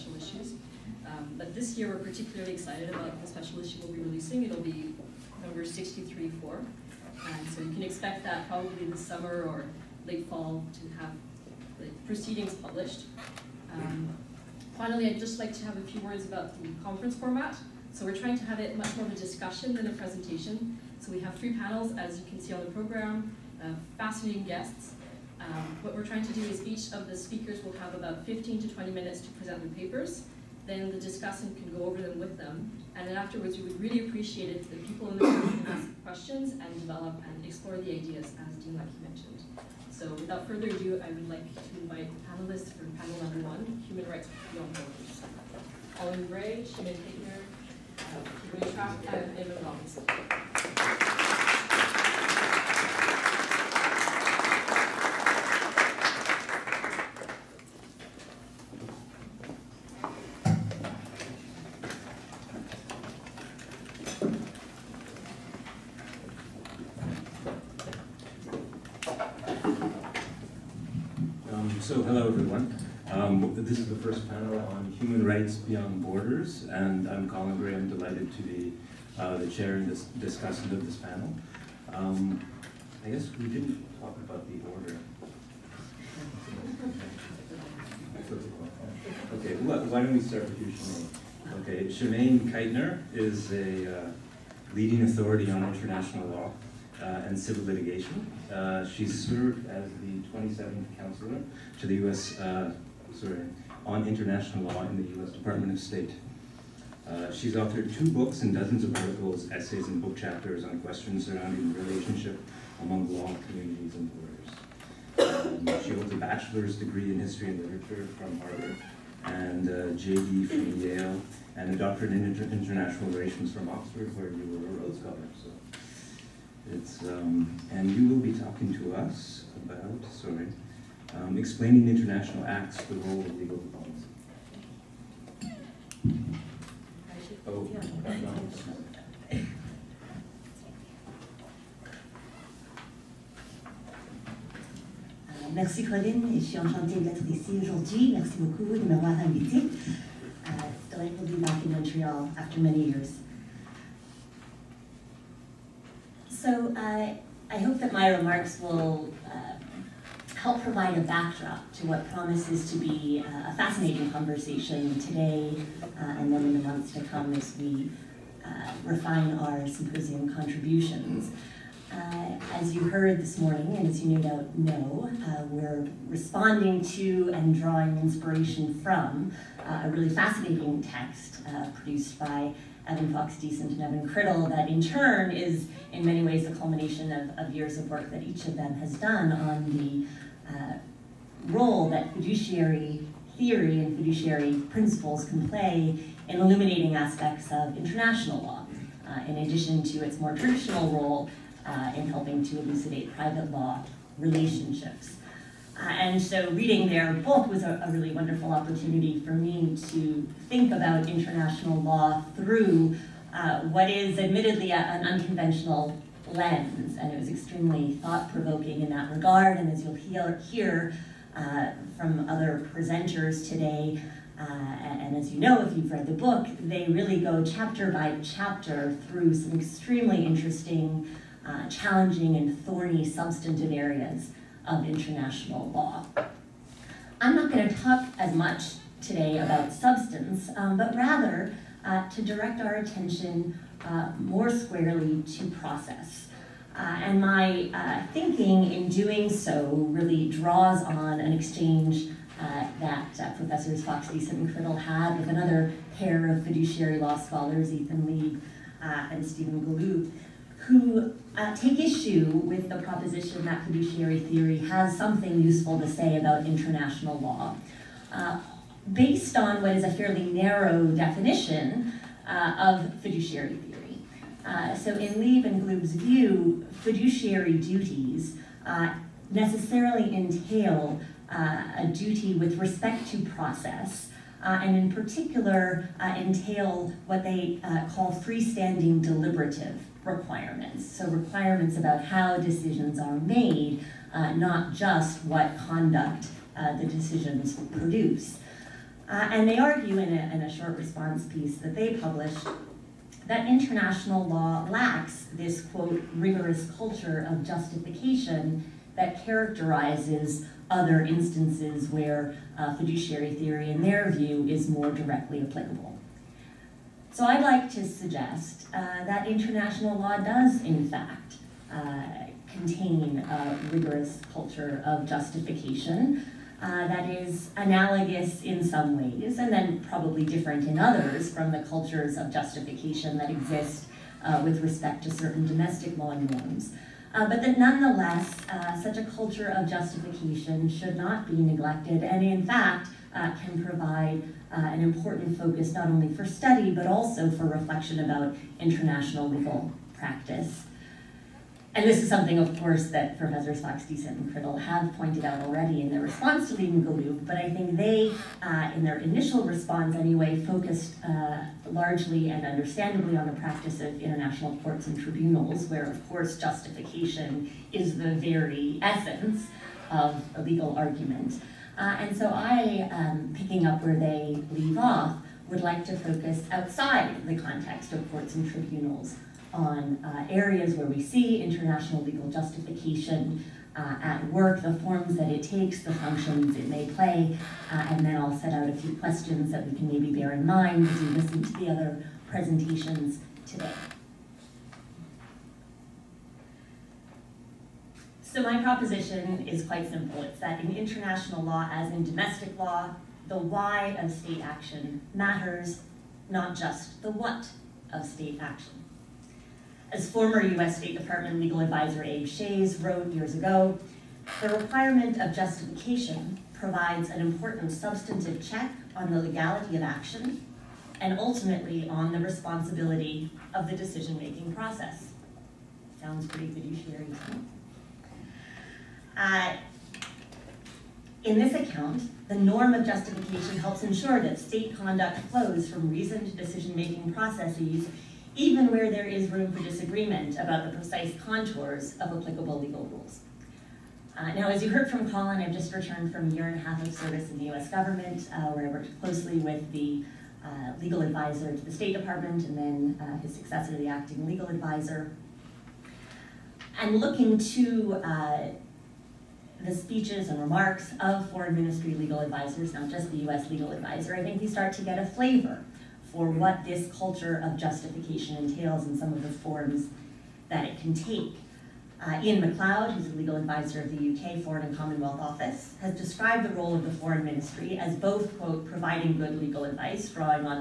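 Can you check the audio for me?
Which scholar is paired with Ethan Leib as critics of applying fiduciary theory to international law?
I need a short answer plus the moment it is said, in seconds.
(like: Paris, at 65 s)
Stephen Galoob, at 259 s.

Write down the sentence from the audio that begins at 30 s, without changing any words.
Then the discussant can go over them with them.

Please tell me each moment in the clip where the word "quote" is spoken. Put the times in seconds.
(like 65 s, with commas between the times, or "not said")
305 s, 478 s.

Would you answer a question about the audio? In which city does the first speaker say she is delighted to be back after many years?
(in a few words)
Montreal.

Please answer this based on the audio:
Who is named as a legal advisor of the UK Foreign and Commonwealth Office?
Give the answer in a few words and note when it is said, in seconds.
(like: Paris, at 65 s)
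Iain Macleod, at 472 s.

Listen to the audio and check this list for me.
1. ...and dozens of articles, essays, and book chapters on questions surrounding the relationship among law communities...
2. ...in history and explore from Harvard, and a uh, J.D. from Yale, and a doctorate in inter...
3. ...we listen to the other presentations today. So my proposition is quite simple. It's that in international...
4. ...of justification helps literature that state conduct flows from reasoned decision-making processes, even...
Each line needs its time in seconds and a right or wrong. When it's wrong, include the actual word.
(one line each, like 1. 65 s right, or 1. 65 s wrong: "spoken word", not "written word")
1. 108 s right
2. 117 s wrong: "literature", not "explore"
3. 390 s right
4. 432 s wrong: "ensure", not "literature".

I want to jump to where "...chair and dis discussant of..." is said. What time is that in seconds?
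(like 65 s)
79 s.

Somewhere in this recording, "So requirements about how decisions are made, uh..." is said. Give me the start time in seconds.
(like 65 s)
290 s.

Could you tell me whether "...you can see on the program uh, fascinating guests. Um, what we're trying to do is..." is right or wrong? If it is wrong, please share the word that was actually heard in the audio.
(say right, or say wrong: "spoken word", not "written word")
right.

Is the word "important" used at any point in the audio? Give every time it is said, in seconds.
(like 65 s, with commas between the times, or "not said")
344 s, 417 s.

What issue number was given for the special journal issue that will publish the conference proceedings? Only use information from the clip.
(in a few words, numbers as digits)
63-4.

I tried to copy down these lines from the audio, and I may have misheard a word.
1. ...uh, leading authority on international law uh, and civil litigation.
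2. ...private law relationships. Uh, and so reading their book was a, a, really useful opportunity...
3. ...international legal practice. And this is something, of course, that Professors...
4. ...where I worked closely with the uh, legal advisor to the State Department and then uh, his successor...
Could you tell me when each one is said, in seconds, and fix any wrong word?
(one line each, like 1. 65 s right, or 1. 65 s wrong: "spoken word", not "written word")
1. 93 s right
2. 203 s wrong: "wonderful", not "useful"
3. 348 s right
4. 448 s right.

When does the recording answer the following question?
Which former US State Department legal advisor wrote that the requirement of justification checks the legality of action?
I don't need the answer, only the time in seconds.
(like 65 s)
412 s.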